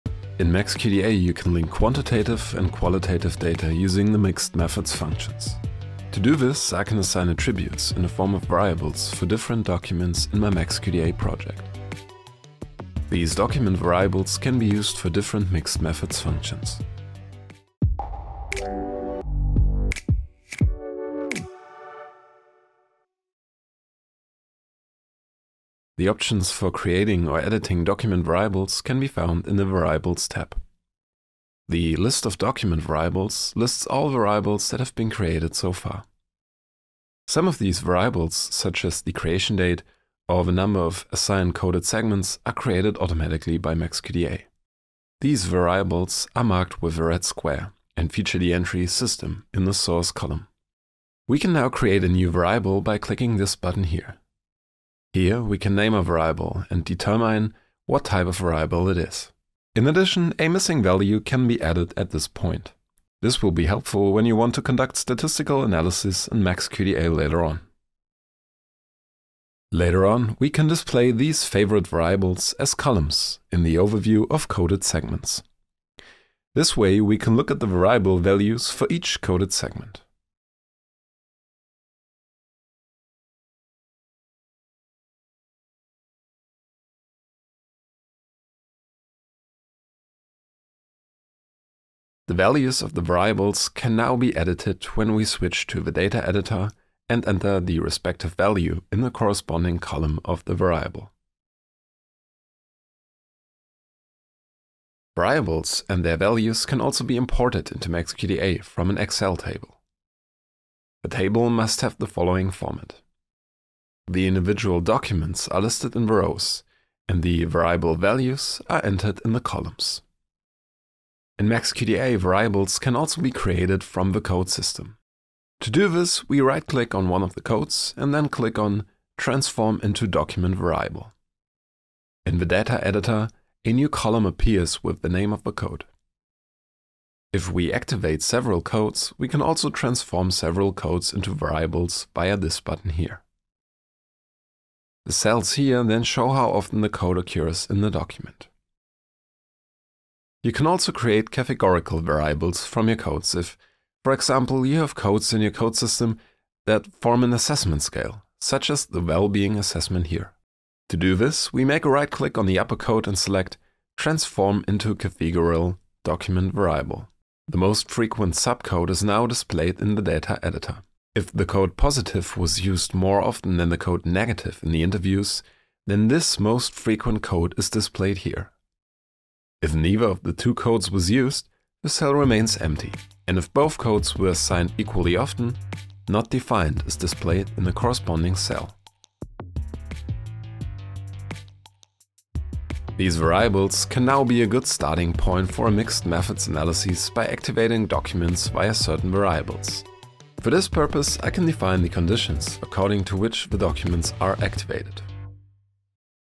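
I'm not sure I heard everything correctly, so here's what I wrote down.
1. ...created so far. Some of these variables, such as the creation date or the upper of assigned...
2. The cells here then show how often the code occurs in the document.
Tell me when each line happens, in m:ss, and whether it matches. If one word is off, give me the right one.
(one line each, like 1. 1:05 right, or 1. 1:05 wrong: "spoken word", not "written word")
1. 0:35 wrong: "number", not "upper"
2. 2:25 right.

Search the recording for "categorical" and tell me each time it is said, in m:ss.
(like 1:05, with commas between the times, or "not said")
2:31, 2:44.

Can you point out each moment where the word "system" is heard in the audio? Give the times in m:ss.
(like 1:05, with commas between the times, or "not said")
0:48, 2:04, 2:35.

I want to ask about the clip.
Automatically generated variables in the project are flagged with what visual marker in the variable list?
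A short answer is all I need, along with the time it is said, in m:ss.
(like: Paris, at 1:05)
a red square, at 0:46.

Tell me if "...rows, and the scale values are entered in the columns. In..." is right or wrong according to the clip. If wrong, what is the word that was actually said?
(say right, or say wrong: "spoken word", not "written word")
wrong: "variable", not "scale".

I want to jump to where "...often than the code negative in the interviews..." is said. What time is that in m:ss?
2:53.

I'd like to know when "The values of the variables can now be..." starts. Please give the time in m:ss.
1:32.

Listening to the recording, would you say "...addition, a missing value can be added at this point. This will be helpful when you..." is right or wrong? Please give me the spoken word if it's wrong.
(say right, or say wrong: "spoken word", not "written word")
right.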